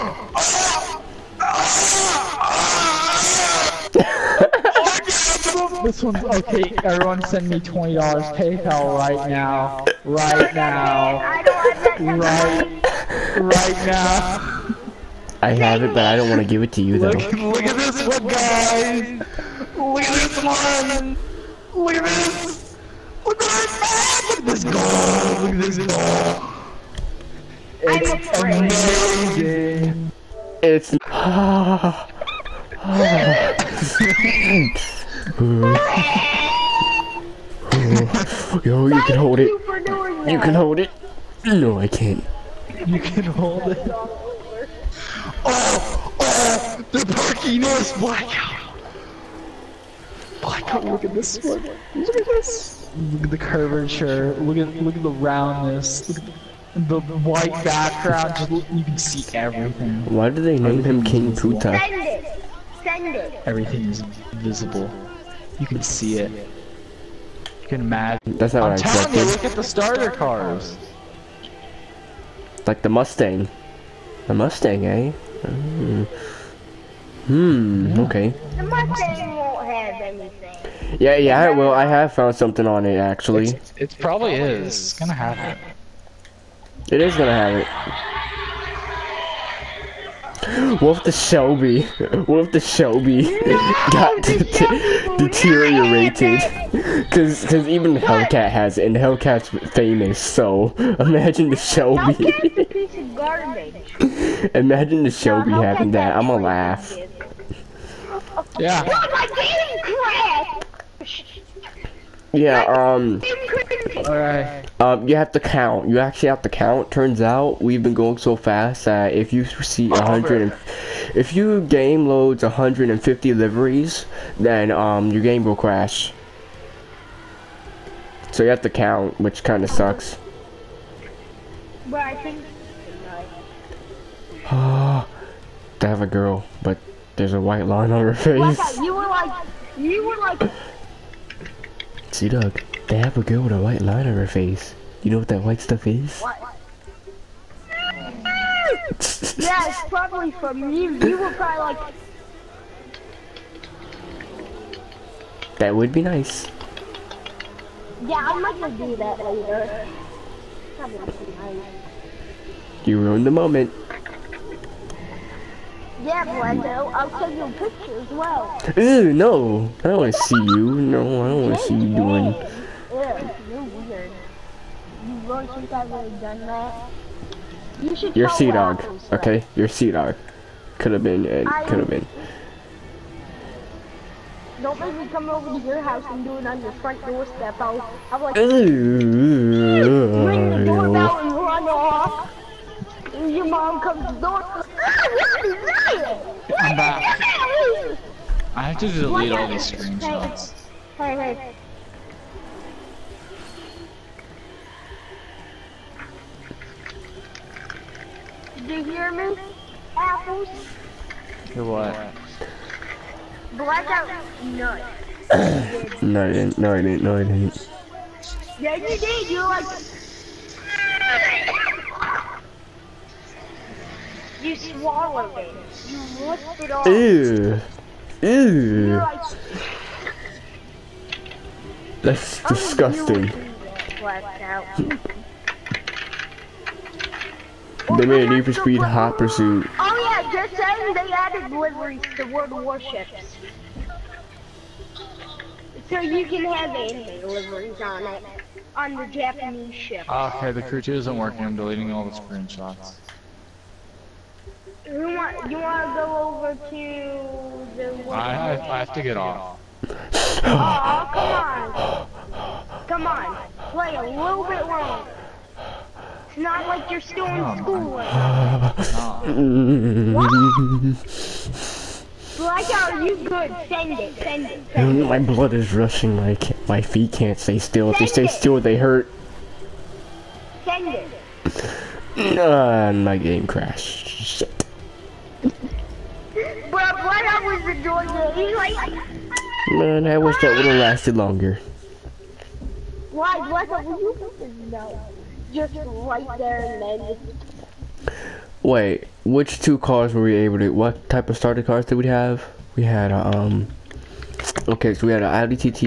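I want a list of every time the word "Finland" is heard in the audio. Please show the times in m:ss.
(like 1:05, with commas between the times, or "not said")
not said.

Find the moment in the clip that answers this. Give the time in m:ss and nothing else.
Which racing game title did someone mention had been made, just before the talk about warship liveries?
3:58.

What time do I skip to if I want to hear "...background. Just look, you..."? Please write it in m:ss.
0:57.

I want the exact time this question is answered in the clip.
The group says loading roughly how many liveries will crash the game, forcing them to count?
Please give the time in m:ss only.
2:02.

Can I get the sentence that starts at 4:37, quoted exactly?
if they stay still, they hurt.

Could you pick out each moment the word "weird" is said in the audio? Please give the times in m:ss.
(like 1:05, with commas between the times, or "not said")
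2:53.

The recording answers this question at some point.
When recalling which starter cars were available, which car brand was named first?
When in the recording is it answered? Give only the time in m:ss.
5:05.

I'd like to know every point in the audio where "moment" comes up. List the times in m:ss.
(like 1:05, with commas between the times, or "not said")
2:43.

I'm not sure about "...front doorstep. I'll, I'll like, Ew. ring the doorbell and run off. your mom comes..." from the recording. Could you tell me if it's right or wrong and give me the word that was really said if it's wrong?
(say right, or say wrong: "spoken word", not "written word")
right.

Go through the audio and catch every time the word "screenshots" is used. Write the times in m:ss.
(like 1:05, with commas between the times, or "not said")
3:19, 4:12.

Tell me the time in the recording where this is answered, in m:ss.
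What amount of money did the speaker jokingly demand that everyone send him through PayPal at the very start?
0:07.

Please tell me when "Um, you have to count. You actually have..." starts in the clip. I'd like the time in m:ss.
1:54.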